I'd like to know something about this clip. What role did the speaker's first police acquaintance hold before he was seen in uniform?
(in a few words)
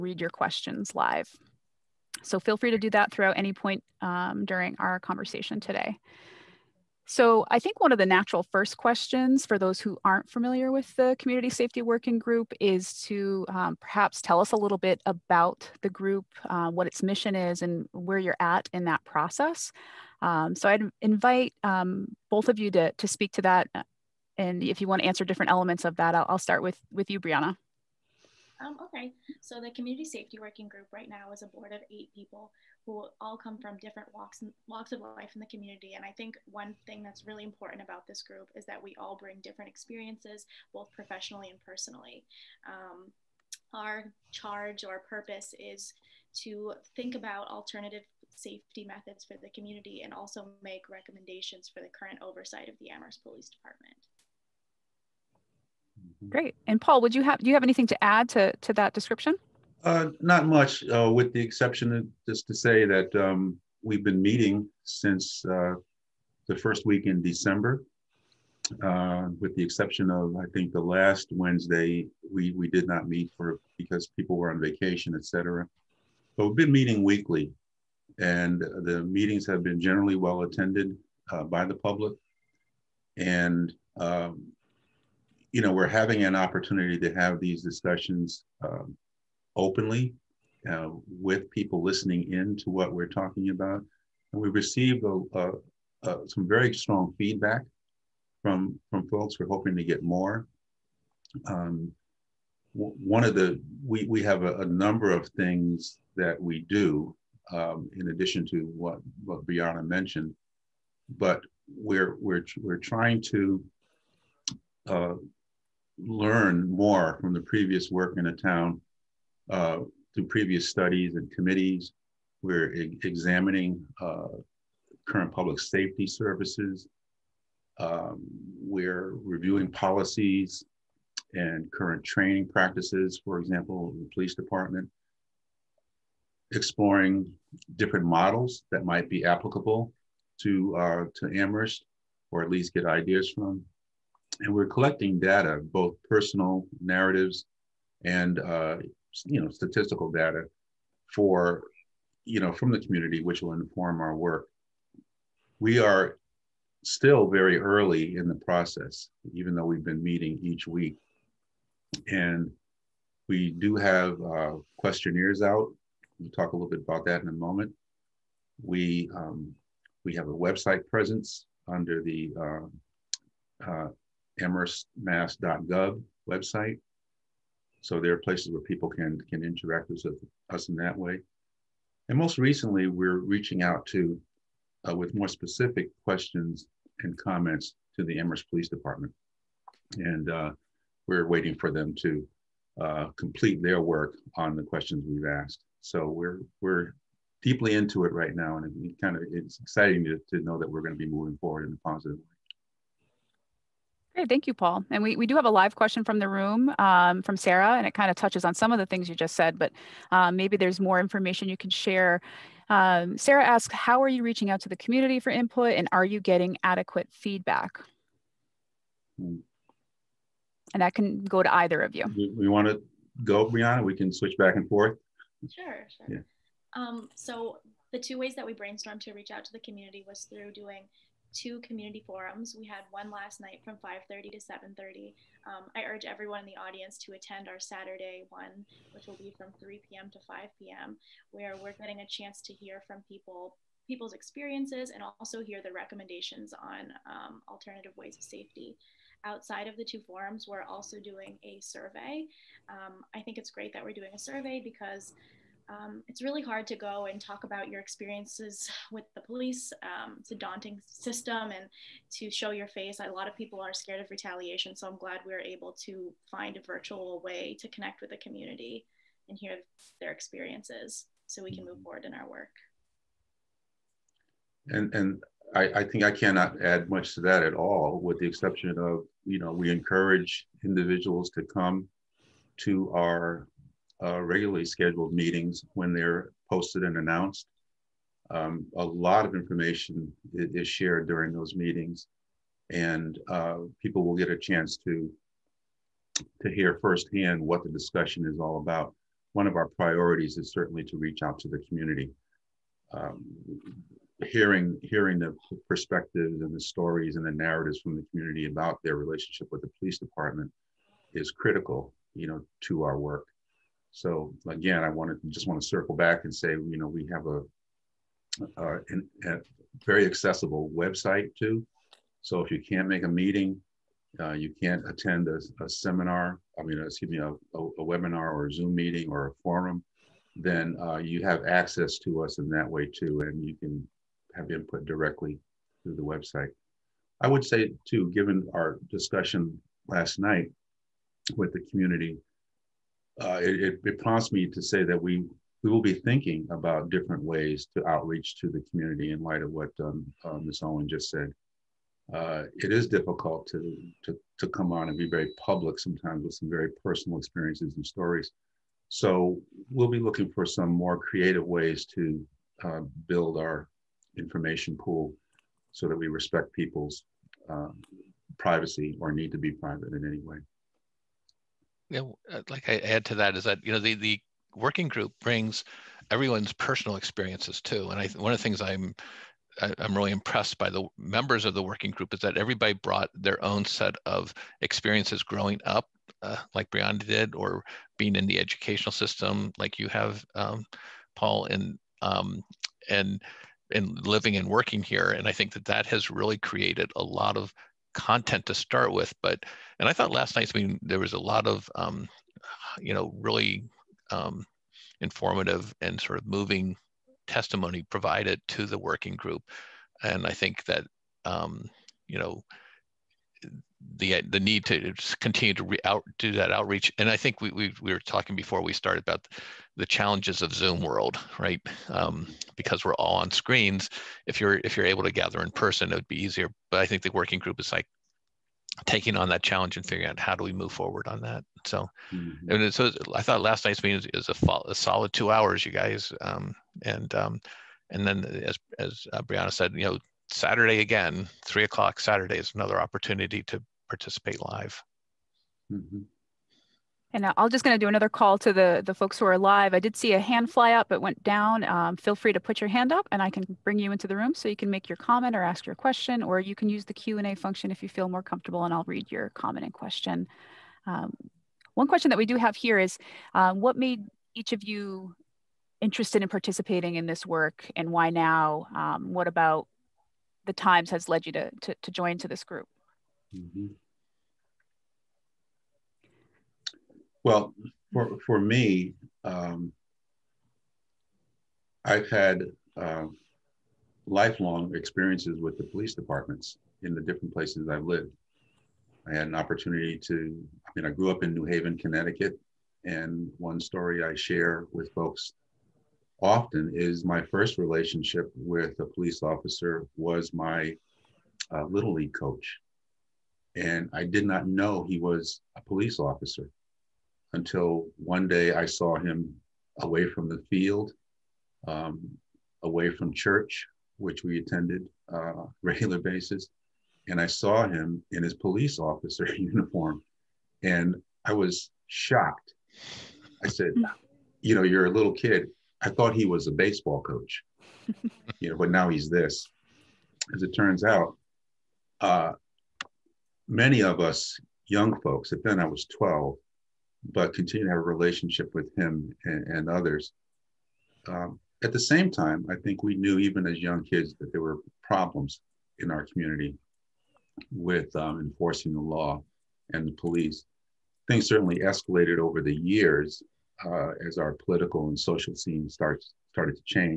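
Little league coach.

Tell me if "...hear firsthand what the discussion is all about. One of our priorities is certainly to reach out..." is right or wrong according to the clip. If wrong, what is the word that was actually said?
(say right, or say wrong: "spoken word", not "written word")
right.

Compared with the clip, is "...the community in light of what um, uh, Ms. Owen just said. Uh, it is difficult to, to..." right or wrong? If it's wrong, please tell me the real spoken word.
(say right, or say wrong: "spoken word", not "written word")
right.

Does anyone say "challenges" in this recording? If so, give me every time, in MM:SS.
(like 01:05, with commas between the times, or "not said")
06:59, 07:09.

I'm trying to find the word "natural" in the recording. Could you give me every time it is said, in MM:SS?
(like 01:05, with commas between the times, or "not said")
00:08.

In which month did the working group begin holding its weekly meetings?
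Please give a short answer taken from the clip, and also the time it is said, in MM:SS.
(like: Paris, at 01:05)
December, at 01:07.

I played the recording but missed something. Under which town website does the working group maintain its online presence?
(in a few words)
amherstma.gov.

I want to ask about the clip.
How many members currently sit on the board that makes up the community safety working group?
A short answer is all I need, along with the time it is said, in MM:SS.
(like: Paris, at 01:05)
8, at 00:31.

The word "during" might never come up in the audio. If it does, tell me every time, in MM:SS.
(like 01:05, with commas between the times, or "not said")
00:04, 04:51.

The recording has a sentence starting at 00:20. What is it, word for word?
Um, so I'd invite um, both of you to, to speak to that.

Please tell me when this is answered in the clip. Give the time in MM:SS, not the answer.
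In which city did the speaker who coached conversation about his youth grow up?
08:11.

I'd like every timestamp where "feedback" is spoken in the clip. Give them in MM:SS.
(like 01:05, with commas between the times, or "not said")
01:37, 03:37.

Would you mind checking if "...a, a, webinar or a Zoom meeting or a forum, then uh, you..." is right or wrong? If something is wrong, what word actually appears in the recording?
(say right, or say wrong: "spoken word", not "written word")
right.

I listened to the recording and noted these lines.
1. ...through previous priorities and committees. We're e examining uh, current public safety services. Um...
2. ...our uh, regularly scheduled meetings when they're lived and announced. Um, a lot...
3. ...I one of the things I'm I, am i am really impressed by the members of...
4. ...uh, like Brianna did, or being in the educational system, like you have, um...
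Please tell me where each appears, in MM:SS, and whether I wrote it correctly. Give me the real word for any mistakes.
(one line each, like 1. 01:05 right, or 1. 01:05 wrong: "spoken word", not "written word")
1. 02:00 wrong: "studies", not "priorities"
2. 04:42 wrong: "posted", not "lived"
3. 06:18 right
4. 06:26 right.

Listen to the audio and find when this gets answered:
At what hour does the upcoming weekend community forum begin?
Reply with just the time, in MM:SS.
03:59.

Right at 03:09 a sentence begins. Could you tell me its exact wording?
And uh, we're waiting for them to uh, complete their work on the questions we've asked.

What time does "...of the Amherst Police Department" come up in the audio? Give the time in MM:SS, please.
00:52.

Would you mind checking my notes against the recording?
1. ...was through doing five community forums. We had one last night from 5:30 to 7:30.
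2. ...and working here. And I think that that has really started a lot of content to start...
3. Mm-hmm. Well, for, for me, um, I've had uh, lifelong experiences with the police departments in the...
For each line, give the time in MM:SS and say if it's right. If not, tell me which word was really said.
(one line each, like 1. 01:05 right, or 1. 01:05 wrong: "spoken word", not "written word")
1. 03:50 wrong: "two", not "five"
2. 06:34 wrong: "created", not "started"
3. 07:53 right.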